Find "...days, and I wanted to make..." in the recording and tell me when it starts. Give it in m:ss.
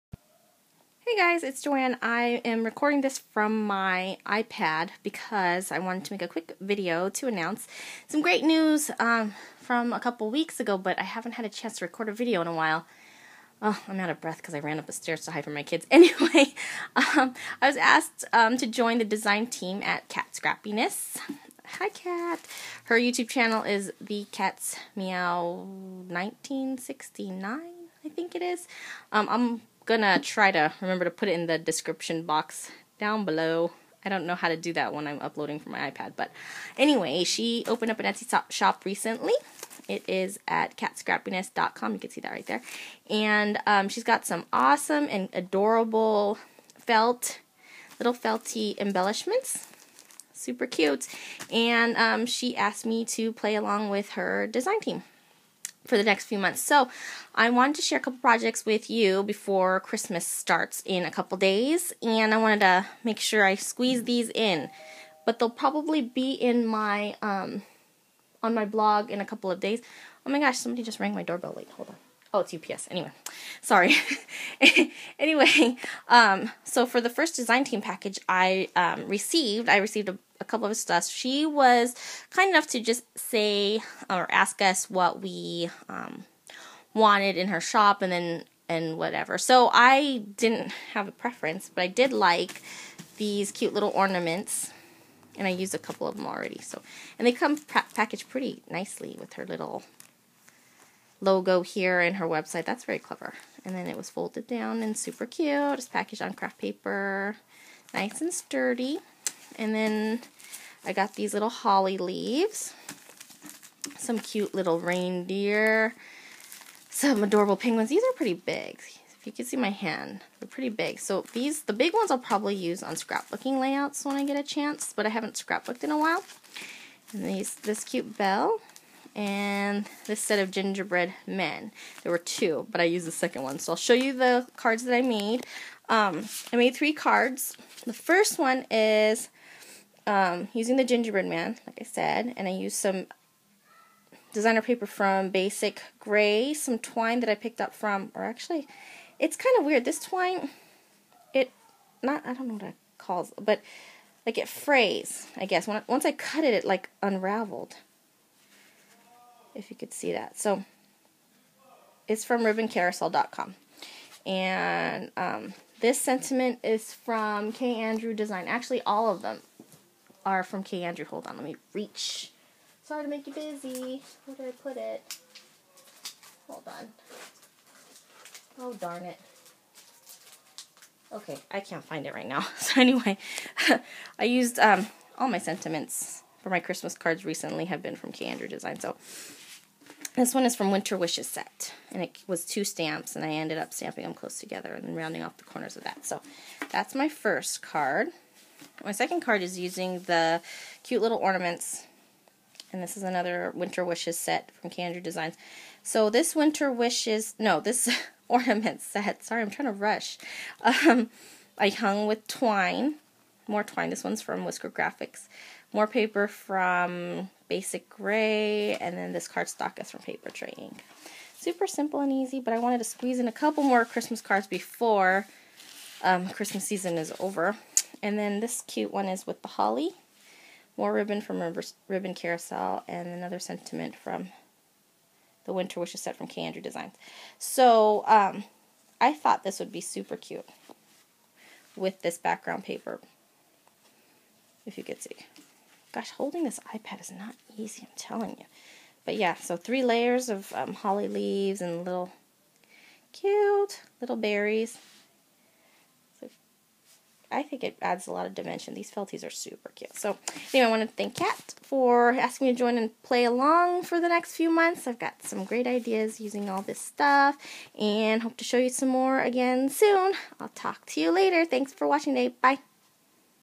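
1:01.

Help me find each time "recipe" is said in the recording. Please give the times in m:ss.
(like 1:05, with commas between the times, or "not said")
not said.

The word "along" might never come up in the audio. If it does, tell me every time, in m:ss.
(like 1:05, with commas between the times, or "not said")
0:53, 4:23.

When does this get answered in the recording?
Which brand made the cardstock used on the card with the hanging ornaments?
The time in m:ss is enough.
3:40.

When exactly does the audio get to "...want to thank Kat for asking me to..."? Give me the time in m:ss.
4:20.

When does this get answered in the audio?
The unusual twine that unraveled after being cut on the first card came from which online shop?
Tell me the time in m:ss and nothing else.
2:42.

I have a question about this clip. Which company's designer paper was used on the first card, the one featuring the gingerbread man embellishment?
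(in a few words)
Basic Gray.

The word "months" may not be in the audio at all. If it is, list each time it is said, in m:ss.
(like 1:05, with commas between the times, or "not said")
0:56, 4:24.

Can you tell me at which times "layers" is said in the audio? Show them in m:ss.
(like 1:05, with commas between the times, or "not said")
4:09.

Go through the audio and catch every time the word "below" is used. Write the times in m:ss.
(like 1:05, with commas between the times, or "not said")
0:33.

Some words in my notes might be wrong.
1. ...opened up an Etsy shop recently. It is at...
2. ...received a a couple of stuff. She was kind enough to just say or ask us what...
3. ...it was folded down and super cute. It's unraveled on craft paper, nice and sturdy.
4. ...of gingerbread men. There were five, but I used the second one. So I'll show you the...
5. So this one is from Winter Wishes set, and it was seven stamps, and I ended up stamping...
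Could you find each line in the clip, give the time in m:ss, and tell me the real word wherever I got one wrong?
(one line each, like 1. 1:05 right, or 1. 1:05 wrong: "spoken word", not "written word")
1. 0:37 right
2. 1:19 right
3. 1:43 wrong: "packaged", not "unraveled"
4. 2:10 wrong: "two", not "five"
5. 3:08 wrong: "two", not "seven".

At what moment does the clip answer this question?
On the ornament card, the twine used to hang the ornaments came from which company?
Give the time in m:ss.
3:34.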